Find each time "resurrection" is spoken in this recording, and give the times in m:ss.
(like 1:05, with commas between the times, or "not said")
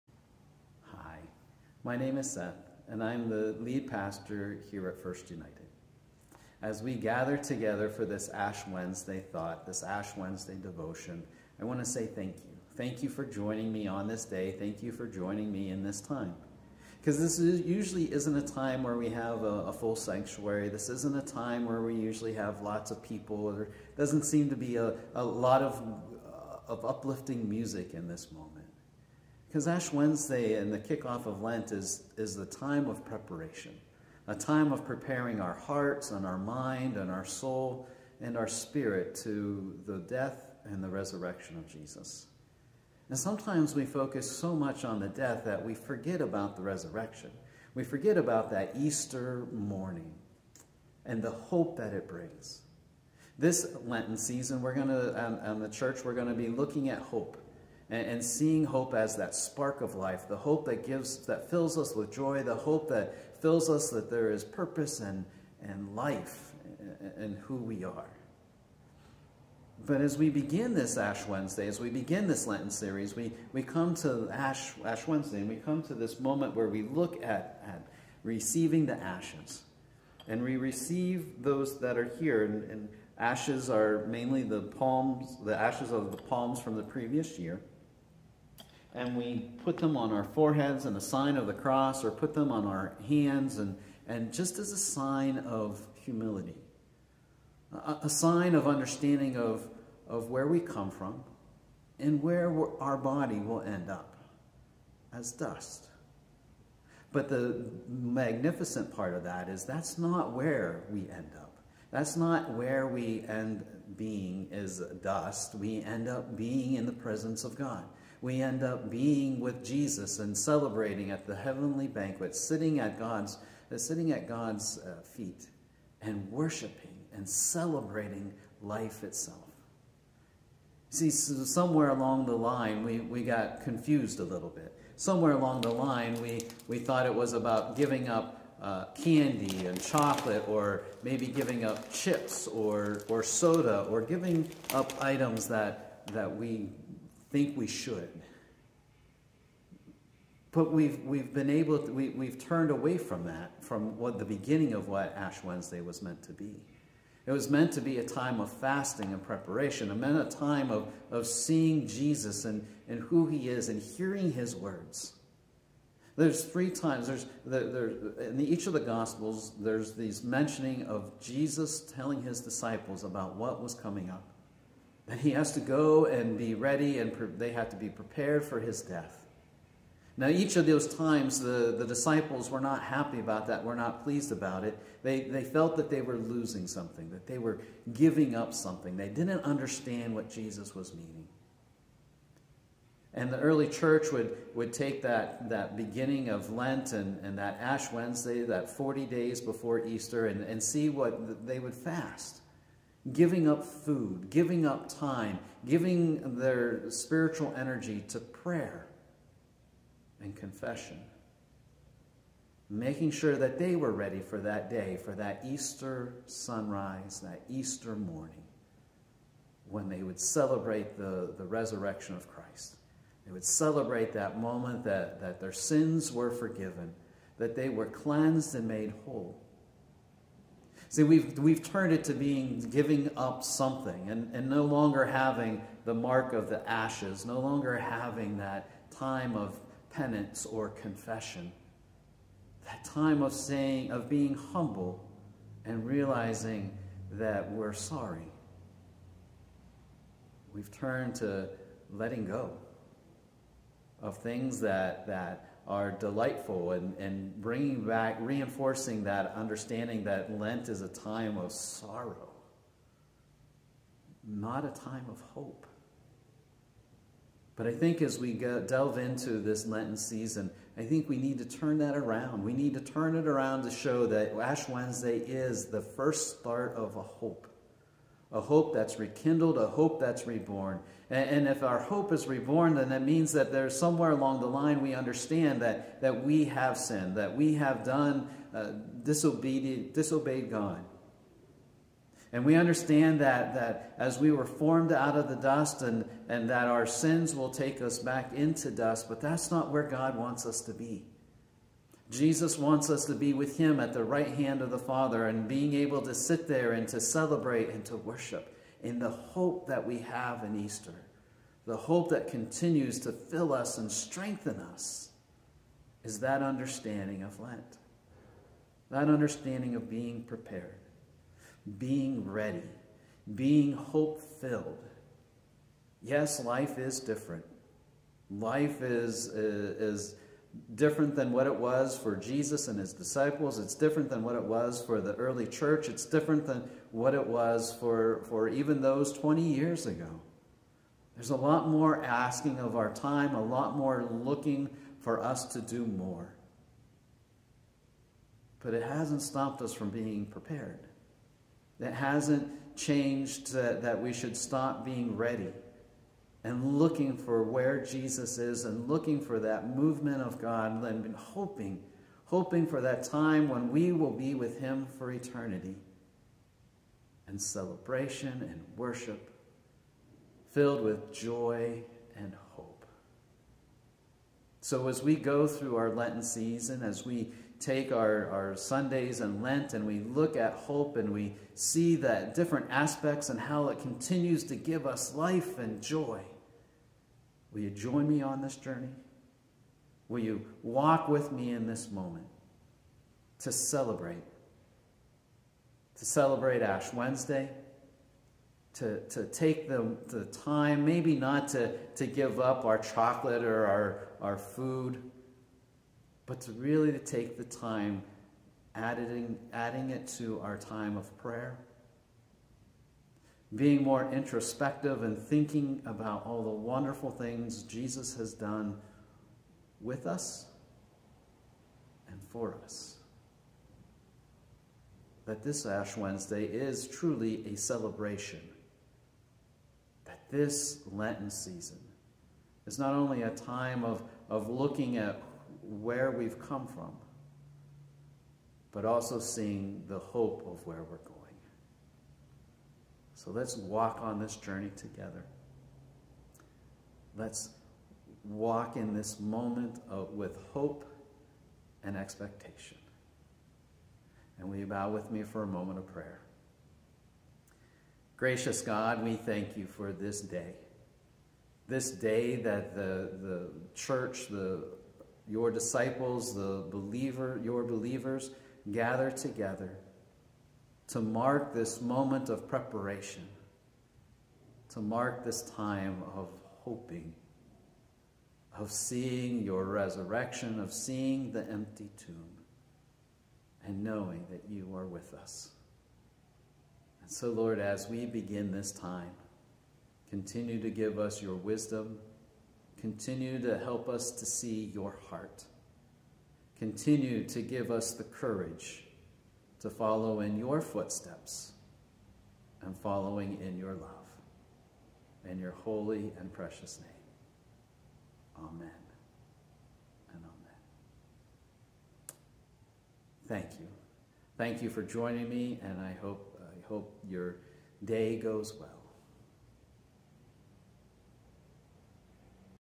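0:40, 0:46, 3:41, 7:59.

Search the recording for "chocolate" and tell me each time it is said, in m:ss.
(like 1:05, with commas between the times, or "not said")
2:19, 6:42.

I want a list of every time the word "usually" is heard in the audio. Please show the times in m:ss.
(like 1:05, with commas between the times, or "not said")
0:17, 0:21.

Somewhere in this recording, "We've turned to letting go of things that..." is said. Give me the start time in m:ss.
4:10.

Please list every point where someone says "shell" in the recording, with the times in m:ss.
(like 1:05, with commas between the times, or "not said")
not said.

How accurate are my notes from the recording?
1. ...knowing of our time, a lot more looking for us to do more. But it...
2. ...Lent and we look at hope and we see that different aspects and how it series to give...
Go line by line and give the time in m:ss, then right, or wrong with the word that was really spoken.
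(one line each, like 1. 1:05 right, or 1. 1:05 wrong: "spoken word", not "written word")
1. 5:42 wrong: "asking", not "knowing"
2. 6:19 wrong: "continues", not "series".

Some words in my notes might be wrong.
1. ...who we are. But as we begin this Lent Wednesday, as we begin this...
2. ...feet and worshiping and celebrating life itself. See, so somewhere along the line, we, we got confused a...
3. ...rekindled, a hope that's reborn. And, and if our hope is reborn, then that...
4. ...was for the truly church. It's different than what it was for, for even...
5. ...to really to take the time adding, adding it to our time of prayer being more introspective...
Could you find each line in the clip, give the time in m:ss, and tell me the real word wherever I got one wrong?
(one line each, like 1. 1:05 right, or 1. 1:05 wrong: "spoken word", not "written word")
1. 1:07 wrong: "Ash", not "Lent"
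2. 2:05 right
3. 4:38 right
4. 5:34 wrong: "early", not "truly"
5. 6:46 right.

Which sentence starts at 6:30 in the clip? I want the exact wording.
Will you walk with me in this moment to celebrate?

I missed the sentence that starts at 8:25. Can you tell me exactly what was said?
In your holy and precious name.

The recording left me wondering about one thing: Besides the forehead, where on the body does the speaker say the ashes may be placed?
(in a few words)
Hands.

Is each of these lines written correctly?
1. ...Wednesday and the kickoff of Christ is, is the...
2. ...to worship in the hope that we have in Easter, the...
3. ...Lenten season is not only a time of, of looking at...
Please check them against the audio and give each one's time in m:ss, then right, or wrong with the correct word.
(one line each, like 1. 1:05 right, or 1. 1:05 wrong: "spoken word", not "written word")
1. 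0:29 wrong: "Lent", not "Christ"
2. 5:07 right
3. 7:10 right.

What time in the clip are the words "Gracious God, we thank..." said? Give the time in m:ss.
7:38.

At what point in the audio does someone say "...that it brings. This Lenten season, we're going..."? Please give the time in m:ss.
0:51.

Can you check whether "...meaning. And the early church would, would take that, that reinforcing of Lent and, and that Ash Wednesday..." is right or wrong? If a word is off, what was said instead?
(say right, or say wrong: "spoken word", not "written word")
wrong: "beginning", not "reinforcing".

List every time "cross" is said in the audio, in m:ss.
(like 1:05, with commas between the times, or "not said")
1:31.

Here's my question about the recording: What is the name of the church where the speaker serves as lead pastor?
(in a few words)
First United.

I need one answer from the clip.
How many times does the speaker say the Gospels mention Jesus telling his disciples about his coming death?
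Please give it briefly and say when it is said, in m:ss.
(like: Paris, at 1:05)
3, at 2:46.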